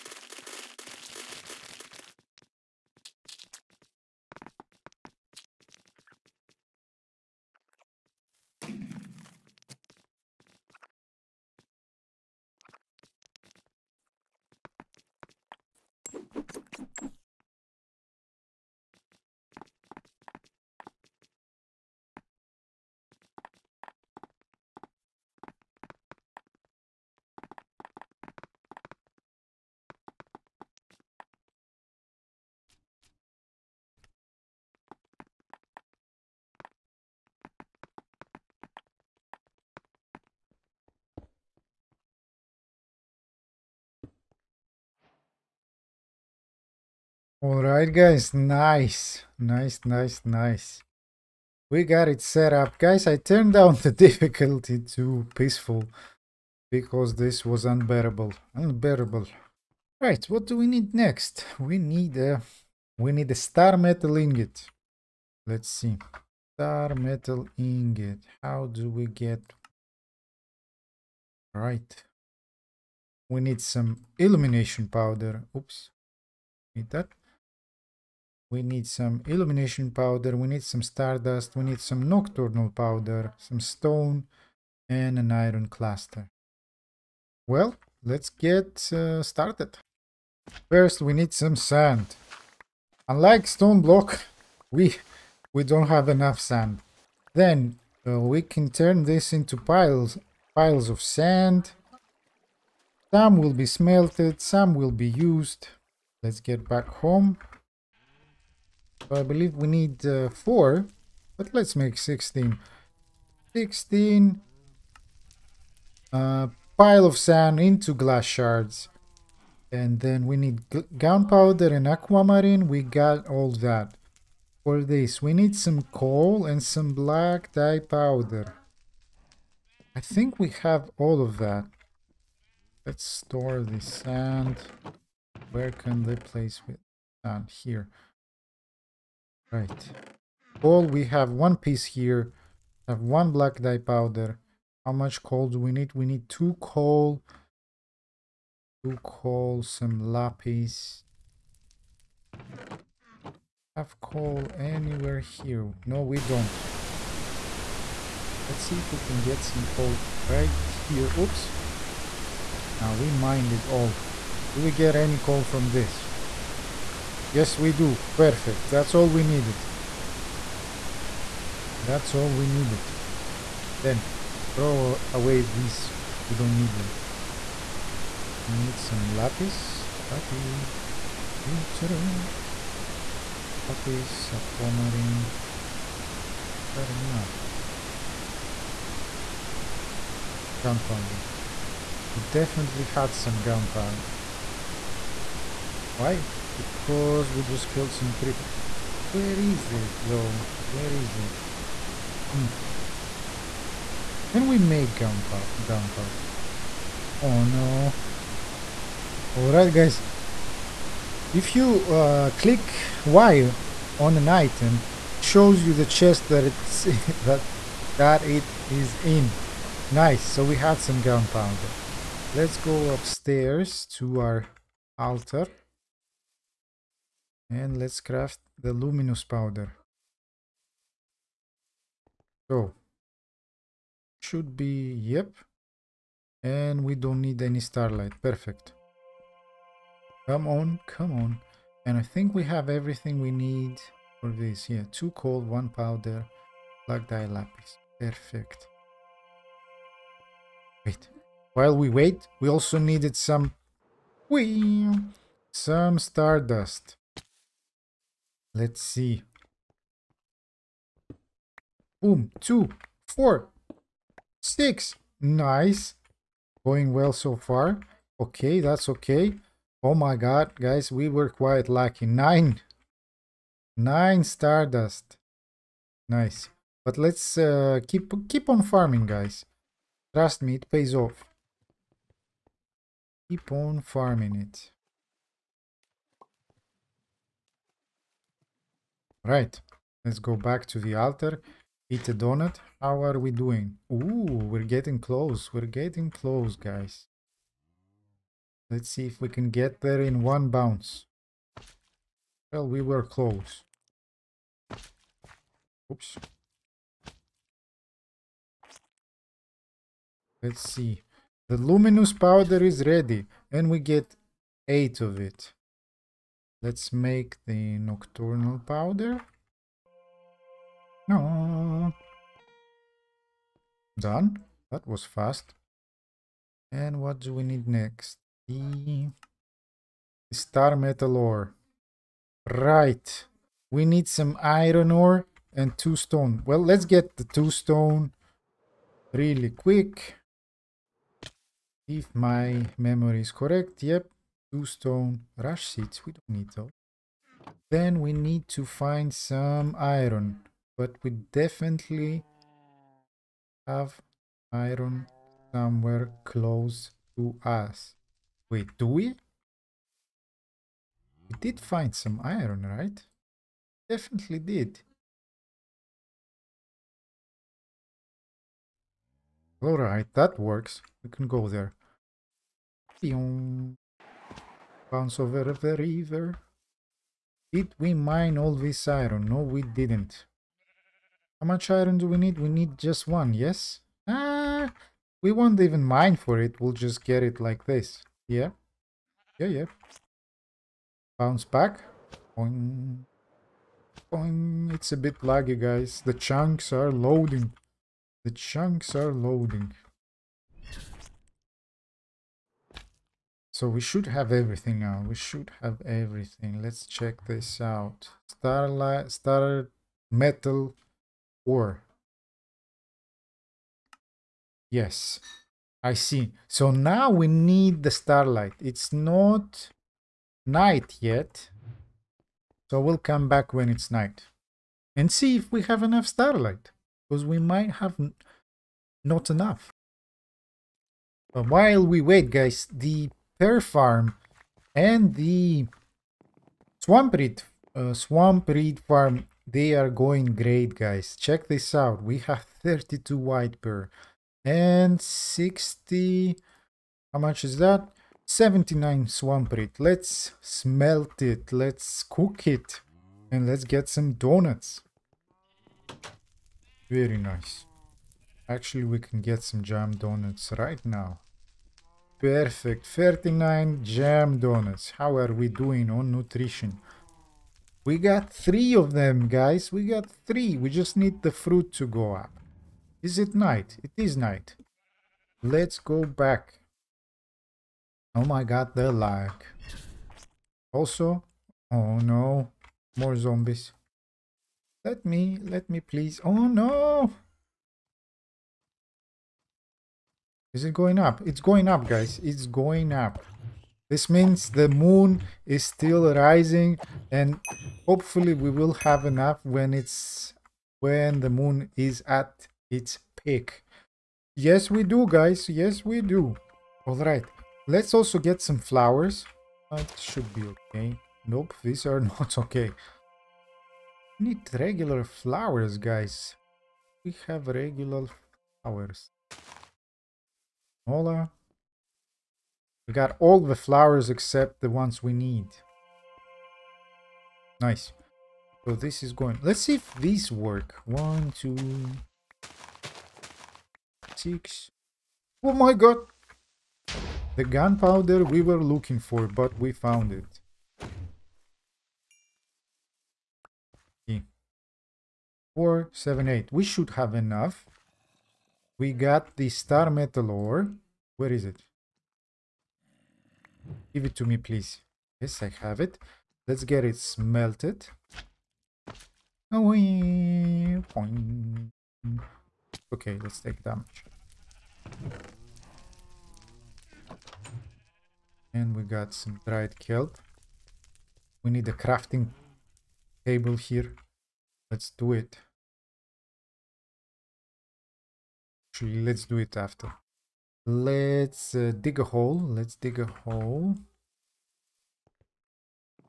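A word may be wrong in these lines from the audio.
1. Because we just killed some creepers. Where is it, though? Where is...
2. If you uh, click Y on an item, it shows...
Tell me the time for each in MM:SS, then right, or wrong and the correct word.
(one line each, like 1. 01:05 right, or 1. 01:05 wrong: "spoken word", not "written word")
1. 03:16 right
2. 03:31 right.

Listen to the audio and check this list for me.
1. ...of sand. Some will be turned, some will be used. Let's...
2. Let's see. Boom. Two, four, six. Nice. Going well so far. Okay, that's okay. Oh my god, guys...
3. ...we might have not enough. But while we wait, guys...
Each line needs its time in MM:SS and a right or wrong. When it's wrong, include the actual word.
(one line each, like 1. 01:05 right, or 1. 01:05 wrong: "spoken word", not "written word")
1. 01:40 wrong: "smelted", not "turned"
2. 04:18 right
3. 07:07 right.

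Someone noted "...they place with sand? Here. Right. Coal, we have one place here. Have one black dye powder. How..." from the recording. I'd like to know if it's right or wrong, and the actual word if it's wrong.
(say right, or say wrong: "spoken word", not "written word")
wrong: "piece", not "place".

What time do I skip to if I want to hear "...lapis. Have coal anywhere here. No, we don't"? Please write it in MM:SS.
02:30.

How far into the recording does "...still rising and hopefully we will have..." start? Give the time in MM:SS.
08:15.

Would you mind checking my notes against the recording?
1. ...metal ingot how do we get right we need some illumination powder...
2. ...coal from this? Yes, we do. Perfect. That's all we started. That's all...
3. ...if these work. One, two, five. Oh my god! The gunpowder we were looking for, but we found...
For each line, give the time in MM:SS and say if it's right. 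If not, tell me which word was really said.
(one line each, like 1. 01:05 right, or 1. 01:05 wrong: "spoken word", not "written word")
1. 01:06 right
2. 02:45 wrong: "needed", not "started"
3. 08:49 wrong: "six", not "five".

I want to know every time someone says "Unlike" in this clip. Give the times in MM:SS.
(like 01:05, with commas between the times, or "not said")
01:33.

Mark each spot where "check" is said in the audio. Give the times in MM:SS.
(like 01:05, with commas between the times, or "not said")
06:46, 07:21.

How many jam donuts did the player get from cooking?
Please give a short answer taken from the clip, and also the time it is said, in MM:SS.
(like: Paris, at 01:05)
39, at 07:42.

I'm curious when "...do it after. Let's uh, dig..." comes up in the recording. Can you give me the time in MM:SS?
09:39.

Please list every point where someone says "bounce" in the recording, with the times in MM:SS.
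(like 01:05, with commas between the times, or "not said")
05:00, 06:14, 06:31.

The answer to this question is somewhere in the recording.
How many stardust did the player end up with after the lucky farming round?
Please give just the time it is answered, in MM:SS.
04:33.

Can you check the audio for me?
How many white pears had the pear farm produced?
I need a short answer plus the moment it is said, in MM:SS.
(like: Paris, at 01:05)
32, at 07:22.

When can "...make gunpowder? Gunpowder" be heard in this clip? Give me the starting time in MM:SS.
03:24.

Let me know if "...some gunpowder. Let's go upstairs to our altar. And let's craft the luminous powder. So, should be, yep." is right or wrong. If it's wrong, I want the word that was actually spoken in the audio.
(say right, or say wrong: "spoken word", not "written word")
right.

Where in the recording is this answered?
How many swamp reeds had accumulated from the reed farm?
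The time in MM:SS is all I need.
07:28.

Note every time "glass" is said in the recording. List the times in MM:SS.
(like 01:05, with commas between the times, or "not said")
01:57.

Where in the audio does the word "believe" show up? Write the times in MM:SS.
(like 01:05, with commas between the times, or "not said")
01:49.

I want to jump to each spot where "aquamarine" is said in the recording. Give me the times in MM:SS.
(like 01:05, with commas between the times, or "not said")
02:01, 03:04.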